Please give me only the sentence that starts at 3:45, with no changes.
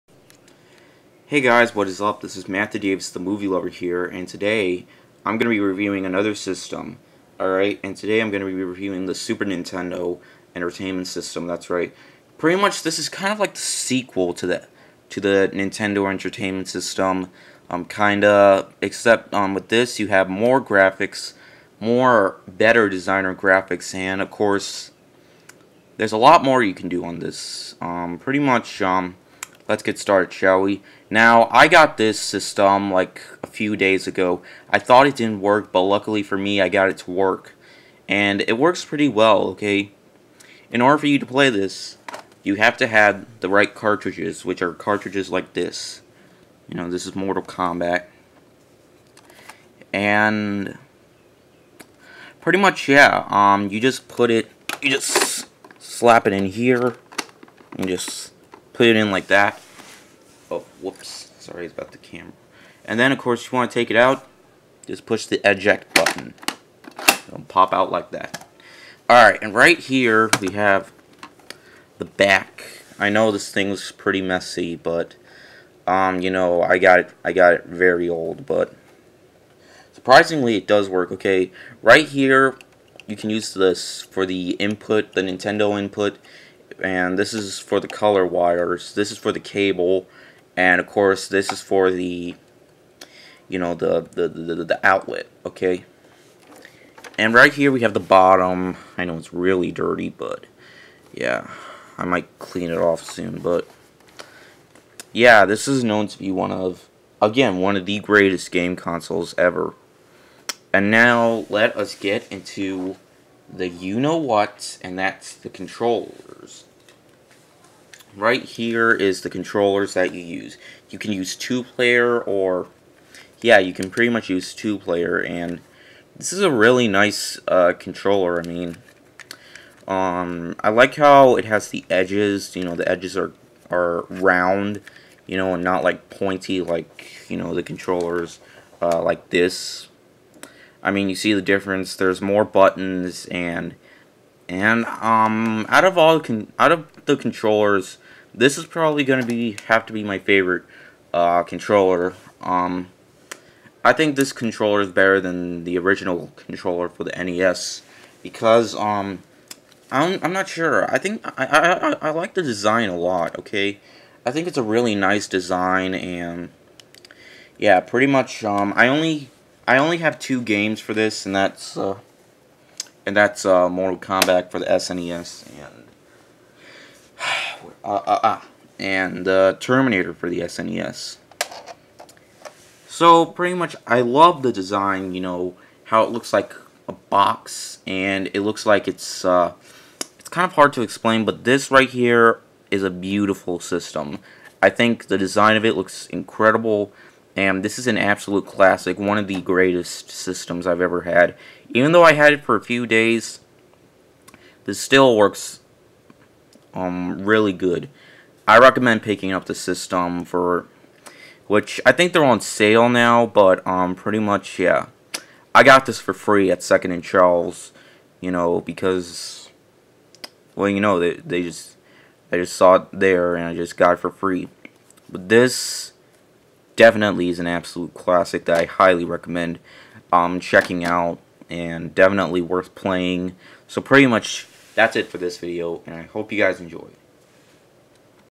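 But this definitely is an absolute classic that I highly recommend um, checking out and definitely worth playing.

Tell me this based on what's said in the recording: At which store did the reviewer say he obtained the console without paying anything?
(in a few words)
Second and Charles.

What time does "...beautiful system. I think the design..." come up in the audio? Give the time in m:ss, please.
3:12.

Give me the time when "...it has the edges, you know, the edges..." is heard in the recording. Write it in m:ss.
2:11.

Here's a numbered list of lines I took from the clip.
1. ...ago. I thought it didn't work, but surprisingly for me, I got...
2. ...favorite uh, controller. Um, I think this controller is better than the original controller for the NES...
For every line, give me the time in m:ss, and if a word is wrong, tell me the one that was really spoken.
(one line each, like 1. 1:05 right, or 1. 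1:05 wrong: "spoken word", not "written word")
1. 0:34 wrong: "luckily", not "surprisingly"
2. 2:30 right.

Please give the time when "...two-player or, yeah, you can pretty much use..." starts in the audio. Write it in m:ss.
2:01.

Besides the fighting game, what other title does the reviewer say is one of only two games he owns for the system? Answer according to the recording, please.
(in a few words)
Terminator.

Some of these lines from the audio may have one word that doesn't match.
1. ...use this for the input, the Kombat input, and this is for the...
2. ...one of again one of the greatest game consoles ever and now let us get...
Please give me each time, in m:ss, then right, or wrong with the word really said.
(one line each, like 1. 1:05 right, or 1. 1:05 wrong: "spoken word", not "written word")
1. 1:23 wrong: "Nintendo", not "Kombat"
2. 1:46 right.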